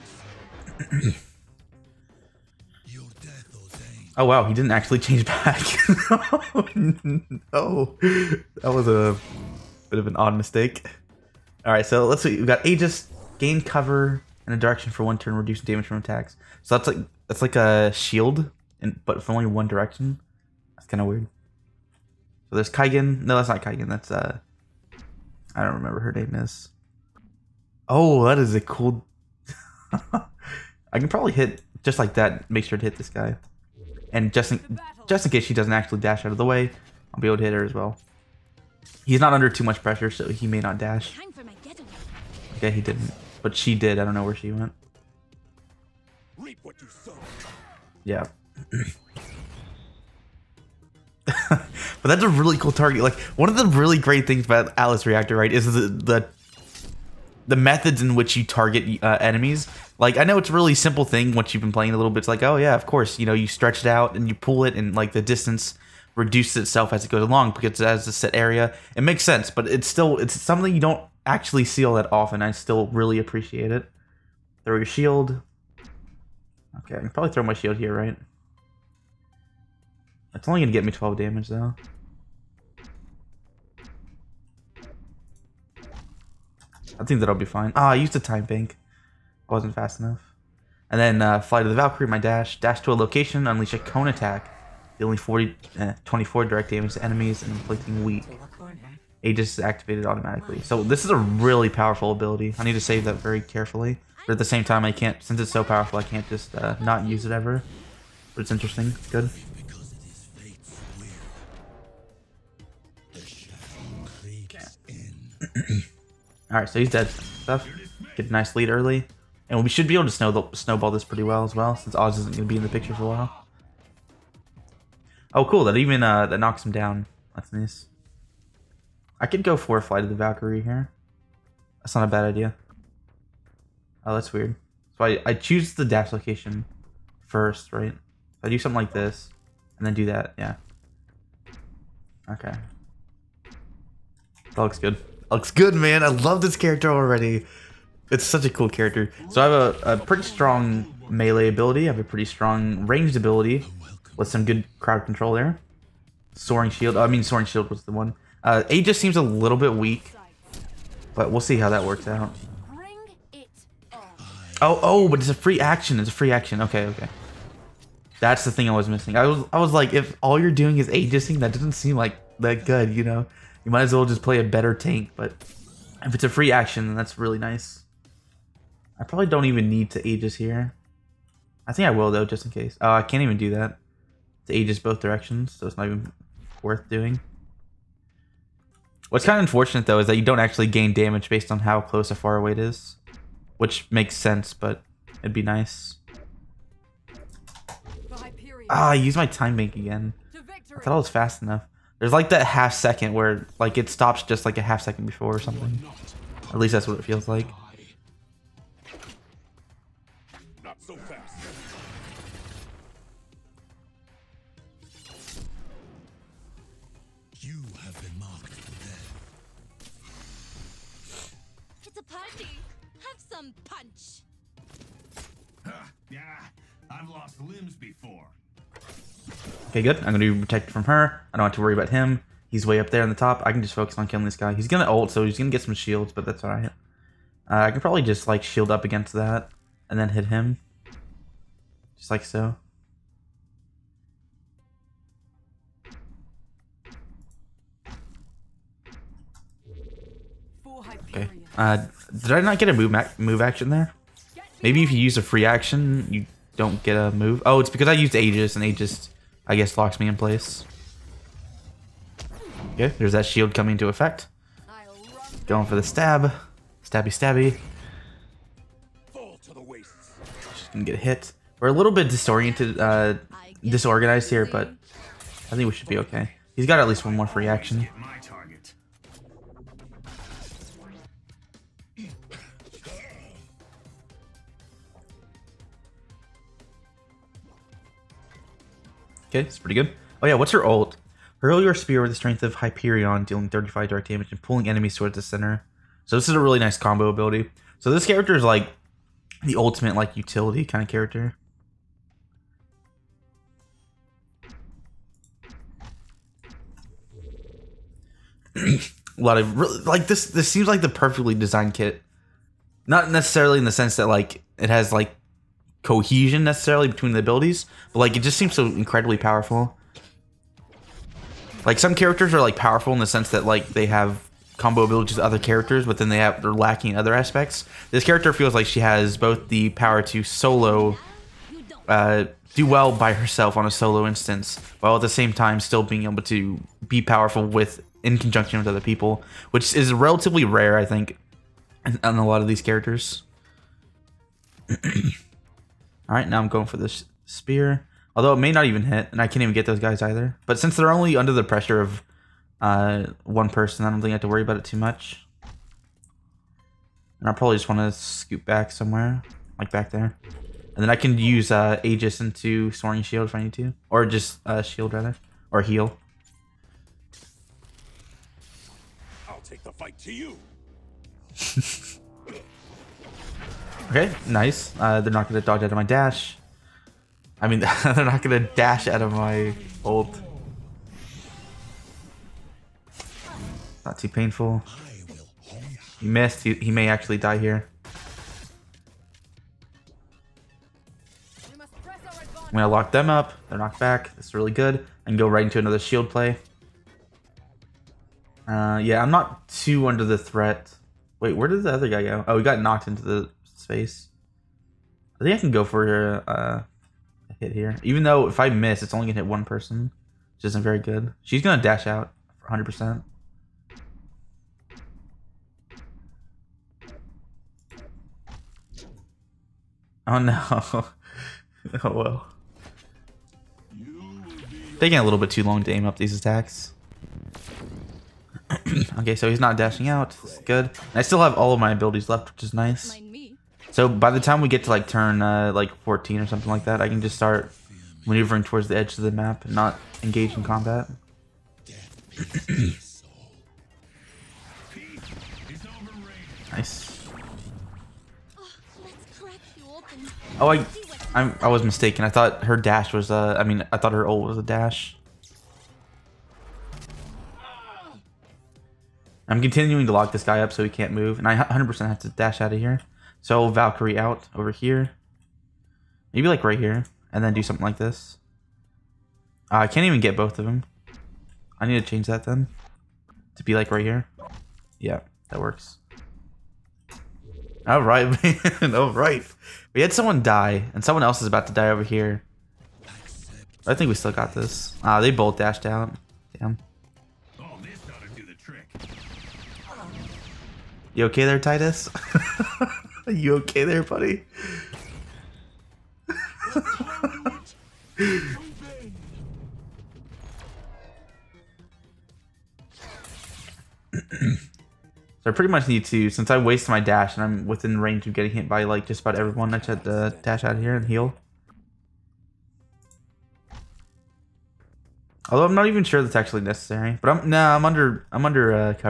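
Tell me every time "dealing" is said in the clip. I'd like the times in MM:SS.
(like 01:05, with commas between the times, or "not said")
04:53.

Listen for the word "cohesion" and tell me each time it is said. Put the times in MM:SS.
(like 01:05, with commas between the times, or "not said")
05:15.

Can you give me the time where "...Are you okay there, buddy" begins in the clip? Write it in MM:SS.
08:13.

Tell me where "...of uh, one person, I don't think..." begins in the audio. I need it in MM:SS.
05:51.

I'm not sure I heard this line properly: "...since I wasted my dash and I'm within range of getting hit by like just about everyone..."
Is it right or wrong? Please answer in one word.
right.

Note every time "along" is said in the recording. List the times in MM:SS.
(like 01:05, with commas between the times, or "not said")
01:07.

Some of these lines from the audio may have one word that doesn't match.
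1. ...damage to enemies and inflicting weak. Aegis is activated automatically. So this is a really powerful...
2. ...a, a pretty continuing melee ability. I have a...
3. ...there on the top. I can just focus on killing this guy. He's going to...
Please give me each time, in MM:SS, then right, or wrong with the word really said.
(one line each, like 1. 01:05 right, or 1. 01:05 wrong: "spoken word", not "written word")
1. 01:36 right
2. 02:29 wrong: "strong", not "continuing"
3. 03:52 right.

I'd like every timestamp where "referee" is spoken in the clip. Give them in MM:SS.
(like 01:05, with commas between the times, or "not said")
not said.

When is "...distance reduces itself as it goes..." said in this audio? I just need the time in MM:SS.
01:05.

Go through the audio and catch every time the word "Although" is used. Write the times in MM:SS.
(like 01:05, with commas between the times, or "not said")
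05:48, 08:35.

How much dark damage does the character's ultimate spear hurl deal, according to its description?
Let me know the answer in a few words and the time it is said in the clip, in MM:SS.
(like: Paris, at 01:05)
35, at 04:53.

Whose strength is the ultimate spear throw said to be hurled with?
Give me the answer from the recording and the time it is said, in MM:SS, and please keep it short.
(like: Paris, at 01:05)
Hyperion, at 04:52.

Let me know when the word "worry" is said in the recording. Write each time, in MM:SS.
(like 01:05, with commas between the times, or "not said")
03:51, 05:54.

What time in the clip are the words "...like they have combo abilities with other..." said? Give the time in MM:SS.
05:23.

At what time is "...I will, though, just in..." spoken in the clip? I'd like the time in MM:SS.
03:01.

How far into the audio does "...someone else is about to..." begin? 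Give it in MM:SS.
08:00.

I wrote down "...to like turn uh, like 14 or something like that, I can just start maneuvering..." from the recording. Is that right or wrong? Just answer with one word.
right.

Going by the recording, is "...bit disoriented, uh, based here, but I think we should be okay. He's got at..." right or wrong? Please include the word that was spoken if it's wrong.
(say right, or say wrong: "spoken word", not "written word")
wrong: "disorganized", not "based".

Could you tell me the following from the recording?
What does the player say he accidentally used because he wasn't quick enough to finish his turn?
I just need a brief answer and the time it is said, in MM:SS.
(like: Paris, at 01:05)
a time bank, at 01:28.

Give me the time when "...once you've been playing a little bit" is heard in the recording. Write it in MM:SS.
01:01.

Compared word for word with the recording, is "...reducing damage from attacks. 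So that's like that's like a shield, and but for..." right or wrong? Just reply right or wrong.
right.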